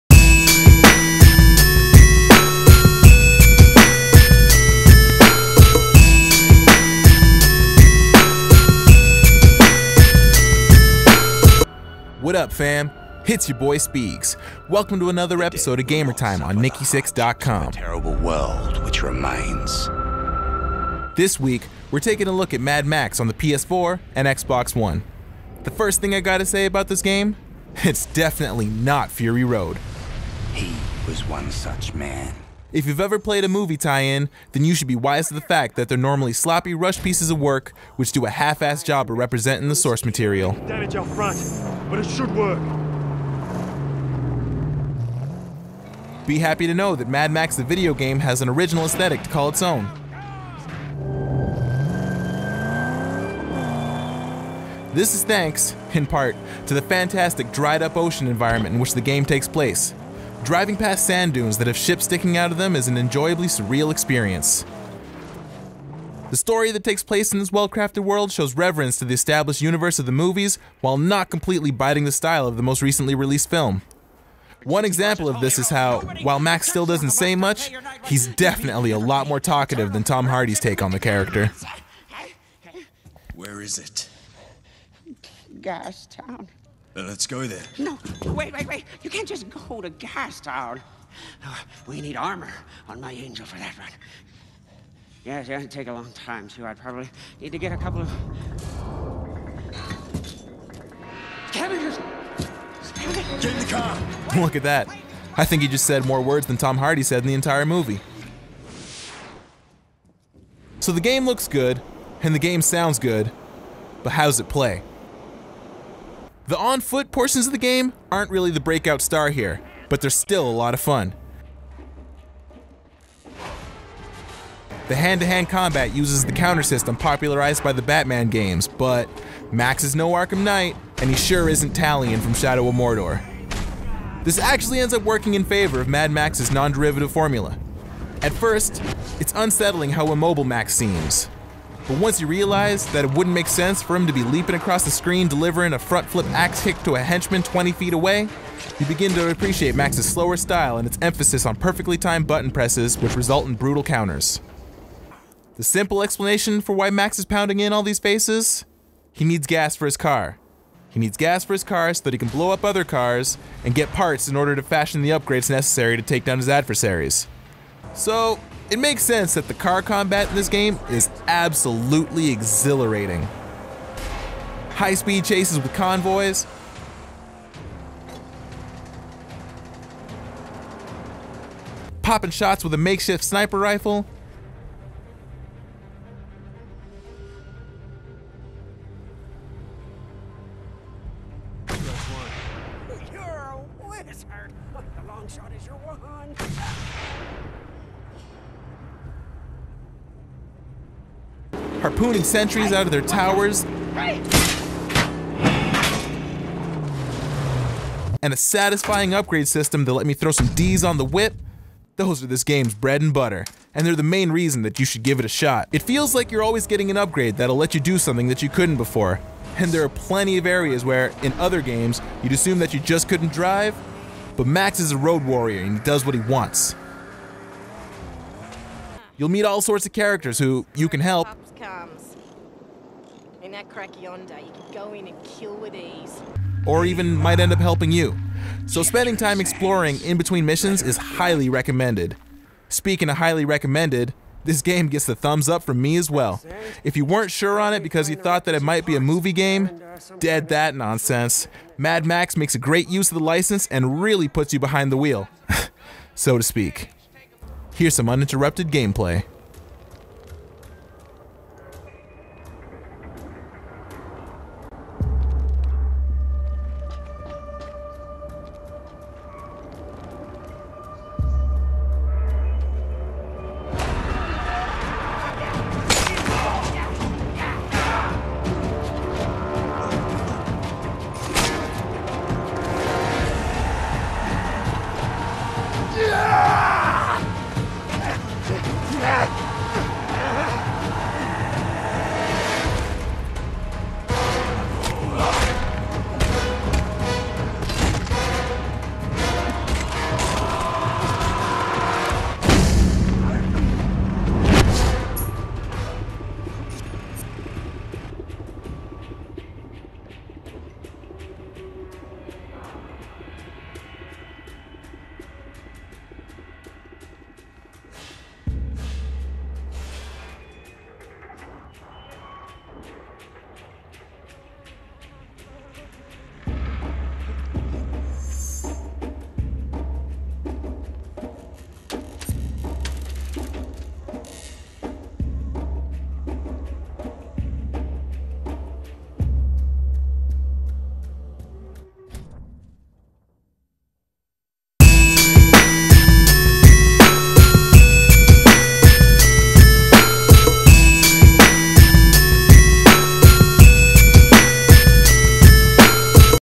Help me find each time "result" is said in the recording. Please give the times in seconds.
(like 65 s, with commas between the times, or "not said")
153 s.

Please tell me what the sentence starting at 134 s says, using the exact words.
This actually ends up working in favor of Mad Max's non-derivative formula.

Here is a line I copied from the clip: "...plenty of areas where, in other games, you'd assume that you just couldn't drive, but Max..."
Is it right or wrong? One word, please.
right.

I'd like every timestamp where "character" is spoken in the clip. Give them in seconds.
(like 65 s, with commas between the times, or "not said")
81 s, 229 s.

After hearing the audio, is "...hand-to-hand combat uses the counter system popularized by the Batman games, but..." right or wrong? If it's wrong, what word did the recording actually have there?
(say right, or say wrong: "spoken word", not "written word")
right.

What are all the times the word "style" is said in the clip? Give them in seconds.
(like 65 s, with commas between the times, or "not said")
72 s, 150 s.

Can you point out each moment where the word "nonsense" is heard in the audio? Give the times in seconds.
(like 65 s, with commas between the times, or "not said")
250 s.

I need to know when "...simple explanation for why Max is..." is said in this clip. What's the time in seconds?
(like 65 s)
155 s.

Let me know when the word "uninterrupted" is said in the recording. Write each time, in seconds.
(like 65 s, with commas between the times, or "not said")
258 s.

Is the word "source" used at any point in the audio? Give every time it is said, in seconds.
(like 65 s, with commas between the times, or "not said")
39 s.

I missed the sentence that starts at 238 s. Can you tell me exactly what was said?
So spending time exploring in between missions is highly recommended.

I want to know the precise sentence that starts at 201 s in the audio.
Harpooning sentries out of their towers.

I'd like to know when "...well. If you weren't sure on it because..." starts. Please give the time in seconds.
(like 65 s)
246 s.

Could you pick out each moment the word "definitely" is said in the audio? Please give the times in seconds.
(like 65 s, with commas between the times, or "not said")
28 s, 78 s.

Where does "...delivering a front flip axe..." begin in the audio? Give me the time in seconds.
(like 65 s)
145 s.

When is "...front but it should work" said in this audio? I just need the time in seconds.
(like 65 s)
41 s.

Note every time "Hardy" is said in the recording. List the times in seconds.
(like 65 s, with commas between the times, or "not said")
80 s, 106 s.